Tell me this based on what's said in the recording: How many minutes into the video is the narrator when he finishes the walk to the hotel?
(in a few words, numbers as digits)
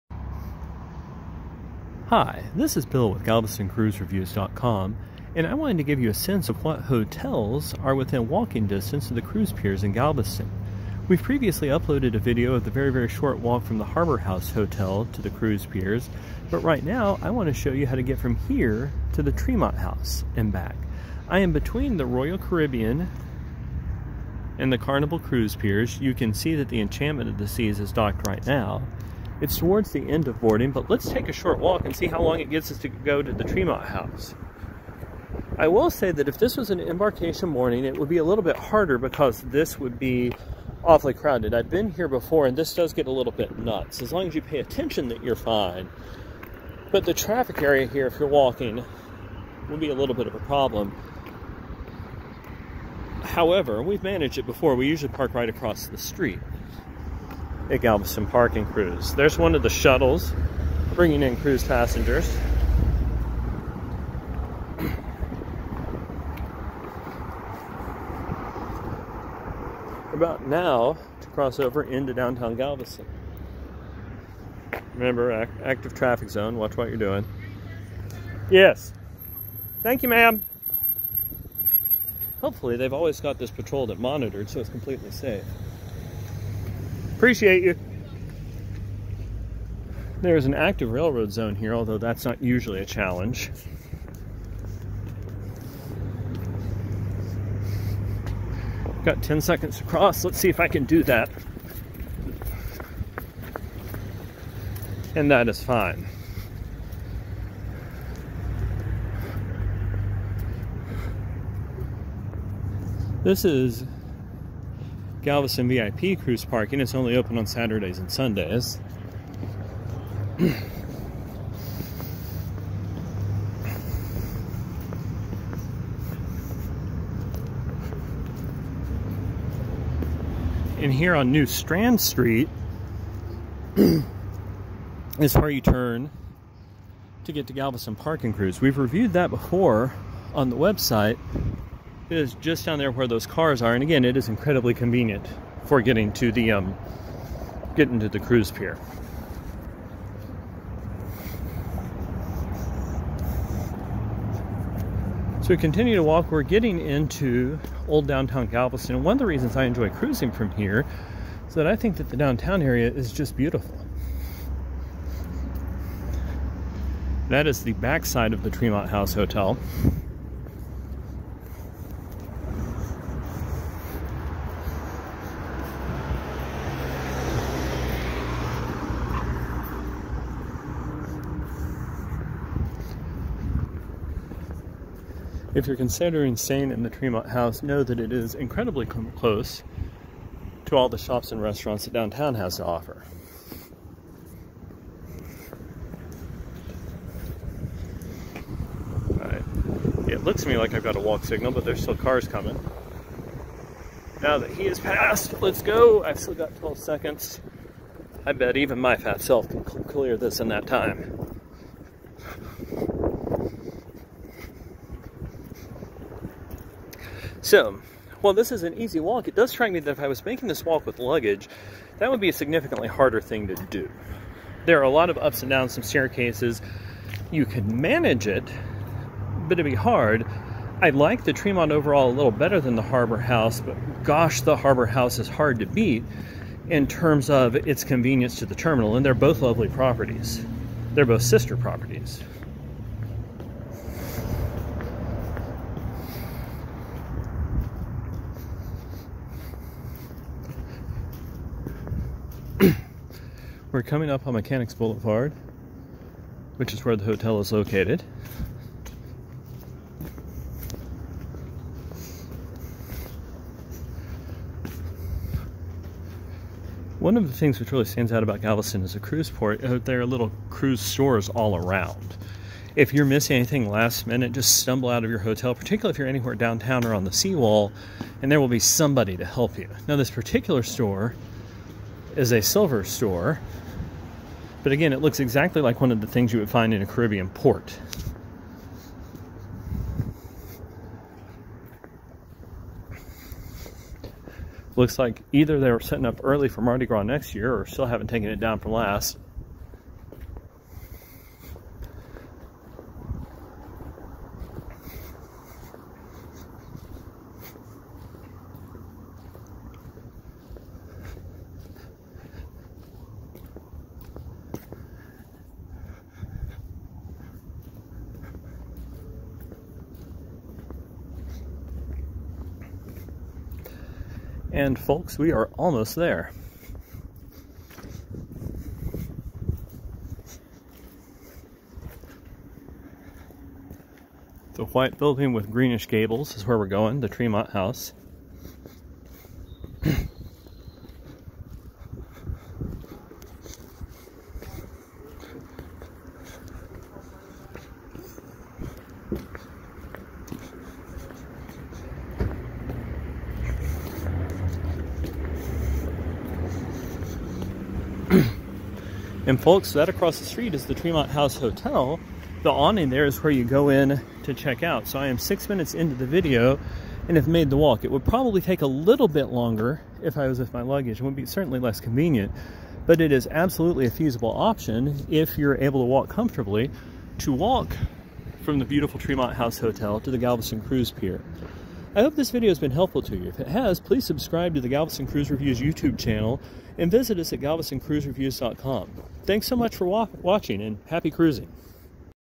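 6.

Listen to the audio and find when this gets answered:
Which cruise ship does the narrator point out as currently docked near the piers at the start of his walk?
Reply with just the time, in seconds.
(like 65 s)
26 s.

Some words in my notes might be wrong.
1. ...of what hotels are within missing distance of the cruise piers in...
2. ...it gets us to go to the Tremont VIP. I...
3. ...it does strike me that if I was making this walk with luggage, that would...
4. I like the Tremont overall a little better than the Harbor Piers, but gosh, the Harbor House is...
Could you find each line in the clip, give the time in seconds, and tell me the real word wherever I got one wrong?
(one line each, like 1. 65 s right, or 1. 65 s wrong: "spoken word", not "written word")
1. 6 s wrong: "walking", not "missing"
2. 32 s wrong: "House", not "VIP"
3. 219 s right
4. 230 s wrong: "House", not "Piers".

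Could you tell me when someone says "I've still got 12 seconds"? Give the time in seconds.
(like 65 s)
206 s.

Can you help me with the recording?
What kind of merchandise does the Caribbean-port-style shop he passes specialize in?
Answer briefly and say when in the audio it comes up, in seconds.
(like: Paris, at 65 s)
Silver, at 282 s.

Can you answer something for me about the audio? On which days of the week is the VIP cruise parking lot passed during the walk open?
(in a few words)
Saturdays and Sundays.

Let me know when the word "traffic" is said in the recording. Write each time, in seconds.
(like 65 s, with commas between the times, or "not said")
47 s, 75 s.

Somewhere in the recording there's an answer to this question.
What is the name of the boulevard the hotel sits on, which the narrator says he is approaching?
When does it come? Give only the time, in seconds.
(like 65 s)
254 s.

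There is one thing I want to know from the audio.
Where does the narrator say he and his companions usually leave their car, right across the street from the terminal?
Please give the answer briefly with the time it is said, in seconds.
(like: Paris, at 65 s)
Galveston Park and Cruise, at 57 s.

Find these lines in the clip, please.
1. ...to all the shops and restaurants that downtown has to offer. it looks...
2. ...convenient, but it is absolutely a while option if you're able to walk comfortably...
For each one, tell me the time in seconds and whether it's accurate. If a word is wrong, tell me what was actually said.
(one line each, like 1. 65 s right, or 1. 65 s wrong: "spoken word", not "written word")
1. 190 s right
2. 371 s wrong: "feasible", not "while".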